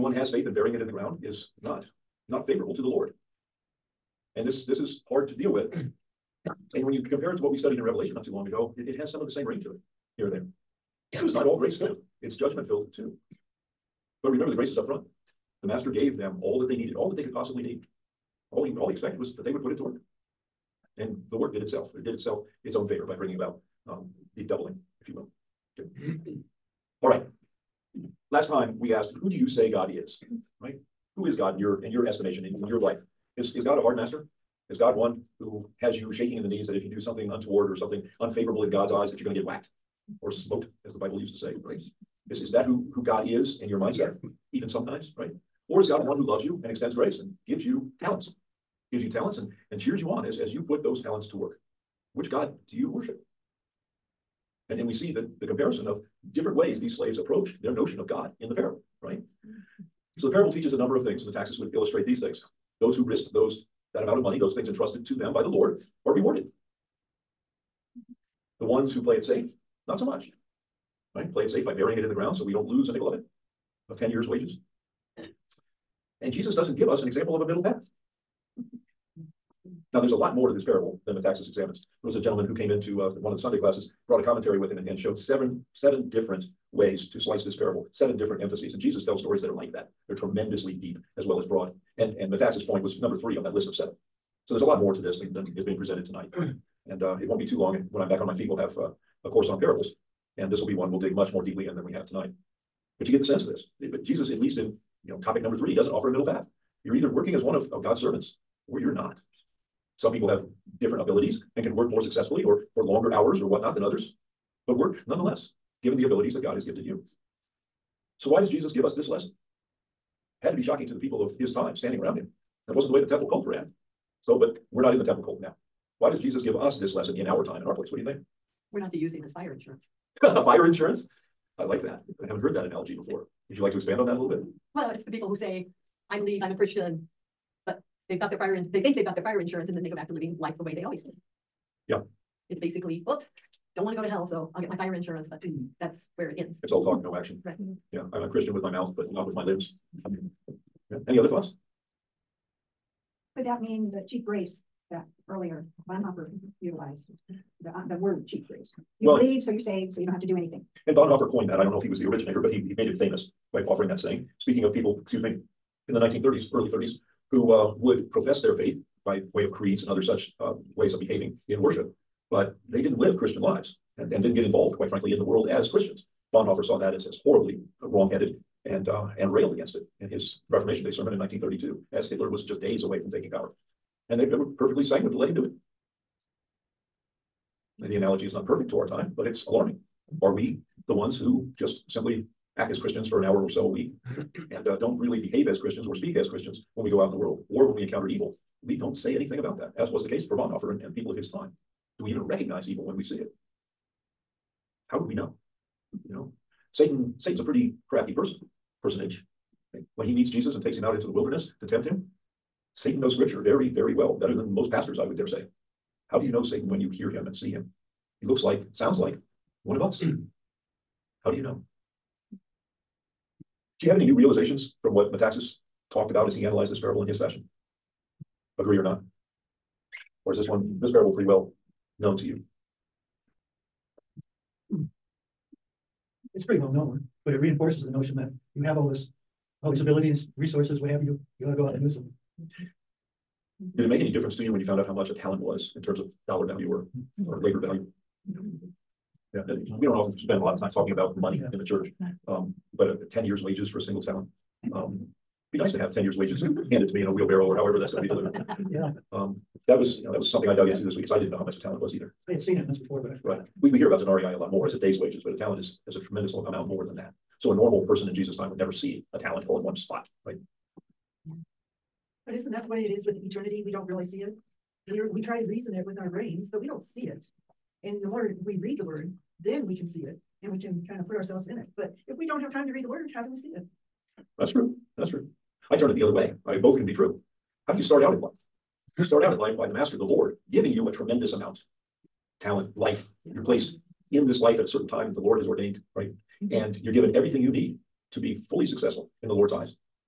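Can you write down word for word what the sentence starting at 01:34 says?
So there's a lot more to this than, than is being presented tonight.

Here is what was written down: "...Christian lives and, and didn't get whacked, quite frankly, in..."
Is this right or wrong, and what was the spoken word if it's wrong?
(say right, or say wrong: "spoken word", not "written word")
wrong: "involved", not "whacked".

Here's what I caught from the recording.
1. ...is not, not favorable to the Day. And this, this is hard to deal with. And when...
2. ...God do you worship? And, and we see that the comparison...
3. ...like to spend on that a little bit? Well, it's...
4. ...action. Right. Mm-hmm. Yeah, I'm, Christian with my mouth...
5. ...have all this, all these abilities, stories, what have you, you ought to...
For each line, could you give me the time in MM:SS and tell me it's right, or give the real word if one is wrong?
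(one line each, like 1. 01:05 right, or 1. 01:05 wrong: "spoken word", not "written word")
1. 00:01 wrong: "Lord", not "Day"
2. 00:52 right
3. 02:13 wrong: "expand", not "spend"
4. 02:27 right
5. 03:58 wrong: "resources", not "stories".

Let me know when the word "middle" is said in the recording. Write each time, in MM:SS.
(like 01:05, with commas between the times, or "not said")
01:17, 01:46.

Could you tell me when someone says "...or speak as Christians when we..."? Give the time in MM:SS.
03:15.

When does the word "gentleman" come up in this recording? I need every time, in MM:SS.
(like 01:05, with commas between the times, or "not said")
01:22.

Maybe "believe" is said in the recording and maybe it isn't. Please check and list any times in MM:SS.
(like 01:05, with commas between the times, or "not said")
02:16, 02:39.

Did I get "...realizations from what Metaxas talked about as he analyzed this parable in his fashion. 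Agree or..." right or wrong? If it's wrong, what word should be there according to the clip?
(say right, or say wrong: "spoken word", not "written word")
right.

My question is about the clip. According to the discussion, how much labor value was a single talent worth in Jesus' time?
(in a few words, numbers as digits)
10 years' wages.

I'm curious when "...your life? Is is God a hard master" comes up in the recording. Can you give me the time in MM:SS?
00:32.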